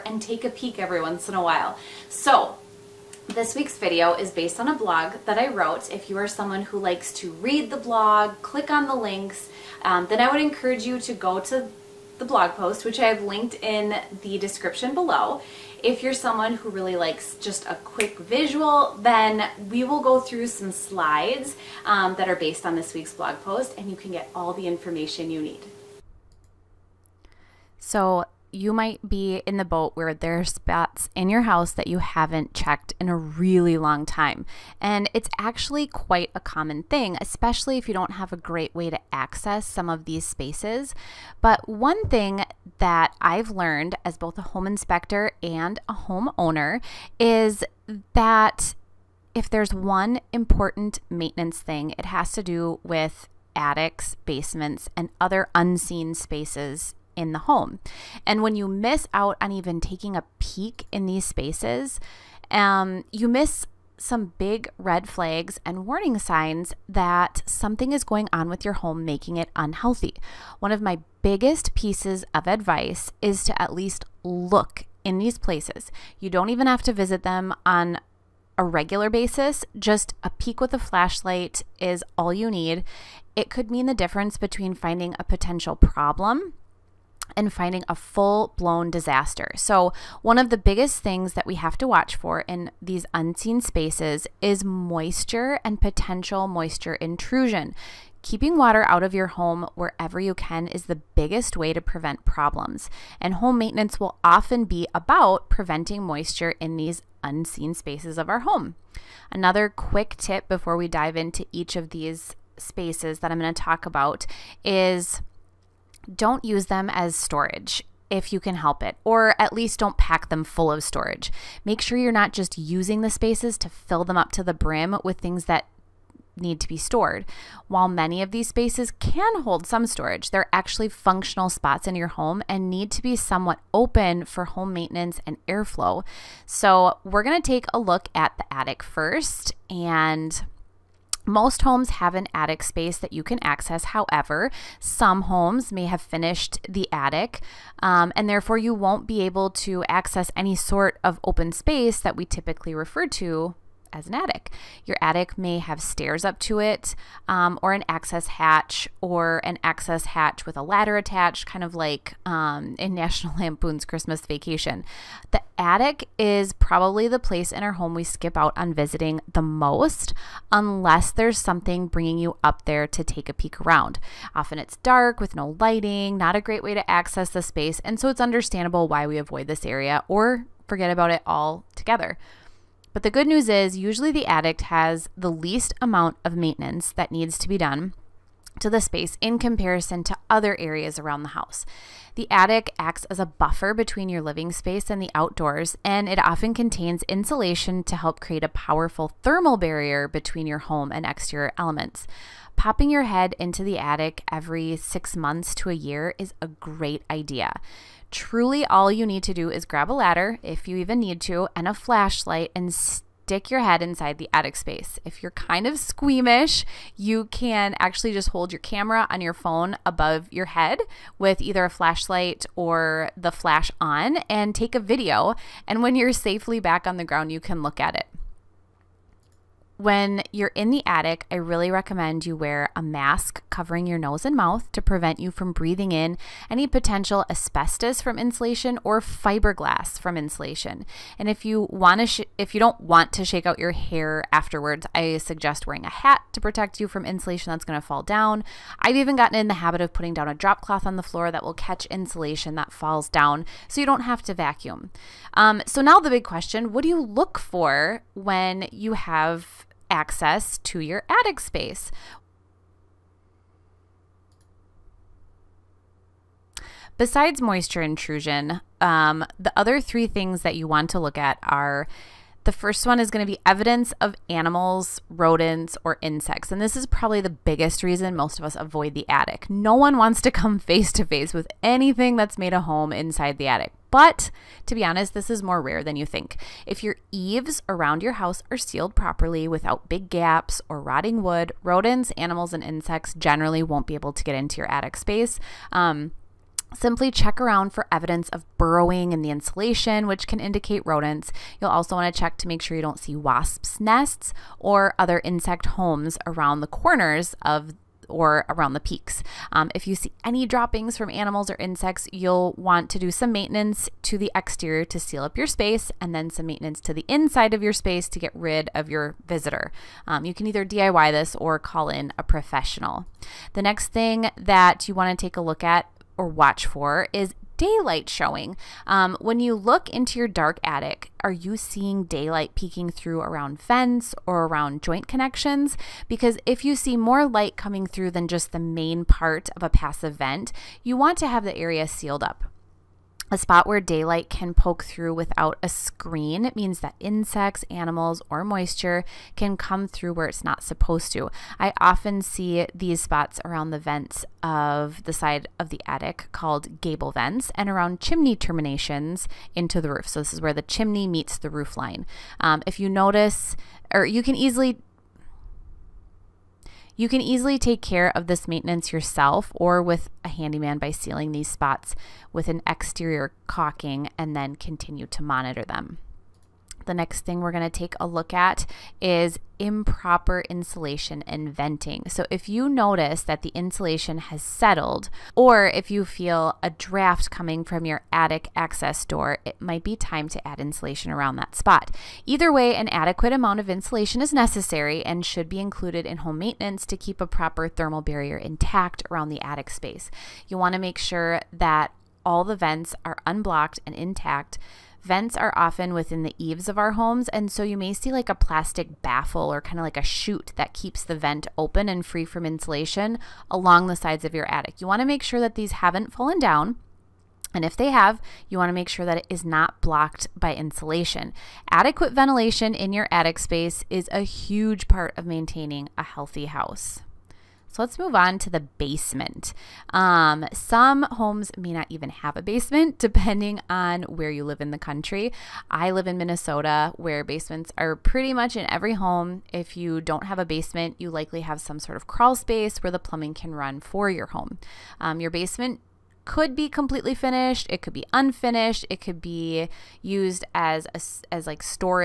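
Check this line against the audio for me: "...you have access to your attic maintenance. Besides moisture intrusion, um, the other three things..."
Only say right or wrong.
wrong.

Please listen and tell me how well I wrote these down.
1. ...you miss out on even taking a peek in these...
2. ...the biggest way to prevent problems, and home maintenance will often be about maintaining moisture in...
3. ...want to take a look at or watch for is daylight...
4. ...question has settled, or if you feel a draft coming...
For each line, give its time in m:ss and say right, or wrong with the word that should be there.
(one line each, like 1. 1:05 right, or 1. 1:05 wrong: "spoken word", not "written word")
1. 0:58 right
2. 1:40 wrong: "preventing", not "maintaining"
3. 5:24 right
4. 6:23 wrong: "insulation", not "question".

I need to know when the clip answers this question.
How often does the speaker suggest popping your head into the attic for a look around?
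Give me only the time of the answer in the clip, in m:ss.
3:24.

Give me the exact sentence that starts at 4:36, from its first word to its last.
And this is probably the biggest reason most of us avoid the attic.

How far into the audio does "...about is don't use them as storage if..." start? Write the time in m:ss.
1:53.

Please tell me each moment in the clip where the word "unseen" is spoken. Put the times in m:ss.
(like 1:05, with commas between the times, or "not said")
0:55, 1:33, 1:47.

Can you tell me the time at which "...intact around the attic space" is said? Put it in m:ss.
6:38.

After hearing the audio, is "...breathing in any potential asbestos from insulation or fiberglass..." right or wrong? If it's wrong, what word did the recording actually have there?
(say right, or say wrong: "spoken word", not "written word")
right.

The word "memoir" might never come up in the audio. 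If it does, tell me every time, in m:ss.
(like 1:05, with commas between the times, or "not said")
not said.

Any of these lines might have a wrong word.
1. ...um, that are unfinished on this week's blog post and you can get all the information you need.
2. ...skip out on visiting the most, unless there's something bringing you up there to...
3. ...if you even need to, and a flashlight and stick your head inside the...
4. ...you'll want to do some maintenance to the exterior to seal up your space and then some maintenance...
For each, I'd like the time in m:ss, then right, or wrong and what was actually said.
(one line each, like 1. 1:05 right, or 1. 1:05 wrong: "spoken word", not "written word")
1. 0:21 wrong: "based", not "unfinished"
2. 2:48 right
3. 3:30 right
4. 5:12 right.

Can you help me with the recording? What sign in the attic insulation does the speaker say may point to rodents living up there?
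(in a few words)
burrowing.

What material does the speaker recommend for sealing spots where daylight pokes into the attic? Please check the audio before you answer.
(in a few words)
exterior caulking.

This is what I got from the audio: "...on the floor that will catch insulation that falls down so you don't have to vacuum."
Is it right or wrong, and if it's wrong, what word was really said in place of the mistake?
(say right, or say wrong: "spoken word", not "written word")
right.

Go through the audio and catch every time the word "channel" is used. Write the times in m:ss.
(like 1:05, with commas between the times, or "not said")
not said.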